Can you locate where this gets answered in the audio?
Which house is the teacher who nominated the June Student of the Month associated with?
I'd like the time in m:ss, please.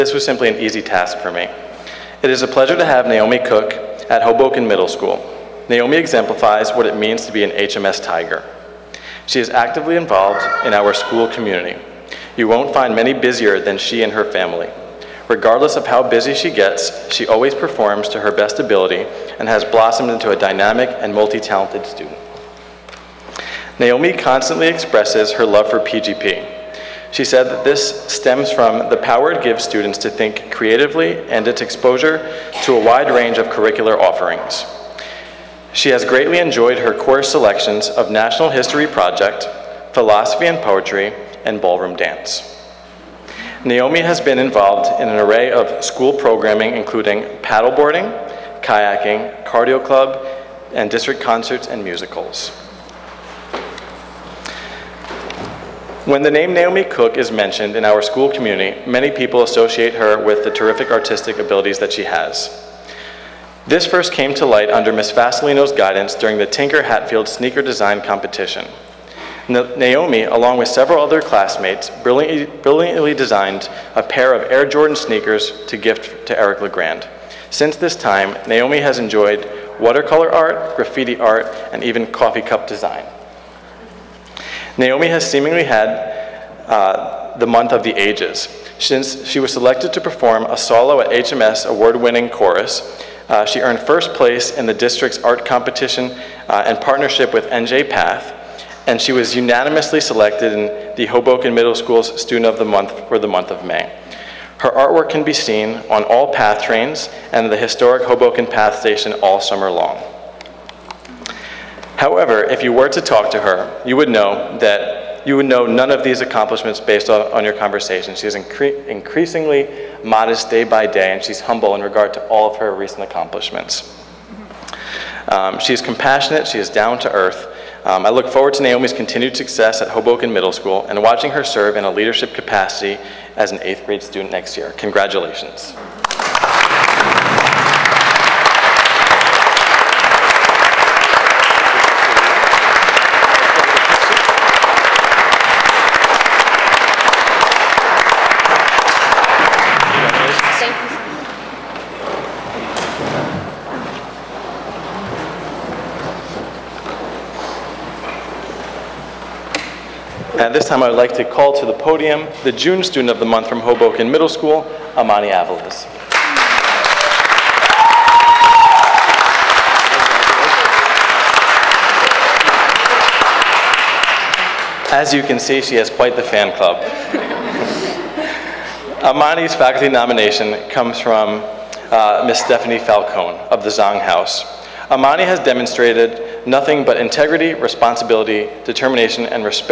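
3:03.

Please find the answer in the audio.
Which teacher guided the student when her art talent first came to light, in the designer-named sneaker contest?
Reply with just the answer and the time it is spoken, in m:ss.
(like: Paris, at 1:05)
Miss Vasilino, at 1:04.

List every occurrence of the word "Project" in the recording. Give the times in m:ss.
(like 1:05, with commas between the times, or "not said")
0:38.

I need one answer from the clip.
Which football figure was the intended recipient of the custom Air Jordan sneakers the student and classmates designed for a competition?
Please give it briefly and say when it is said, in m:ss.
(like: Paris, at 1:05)
Eric LeGrand, at 1:16.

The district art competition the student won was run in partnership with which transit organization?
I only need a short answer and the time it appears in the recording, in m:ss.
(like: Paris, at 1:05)
NJ Path, at 1:37.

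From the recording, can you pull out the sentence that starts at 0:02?
It is a pleasure to have Naomi Cook at Hoboken Middle School.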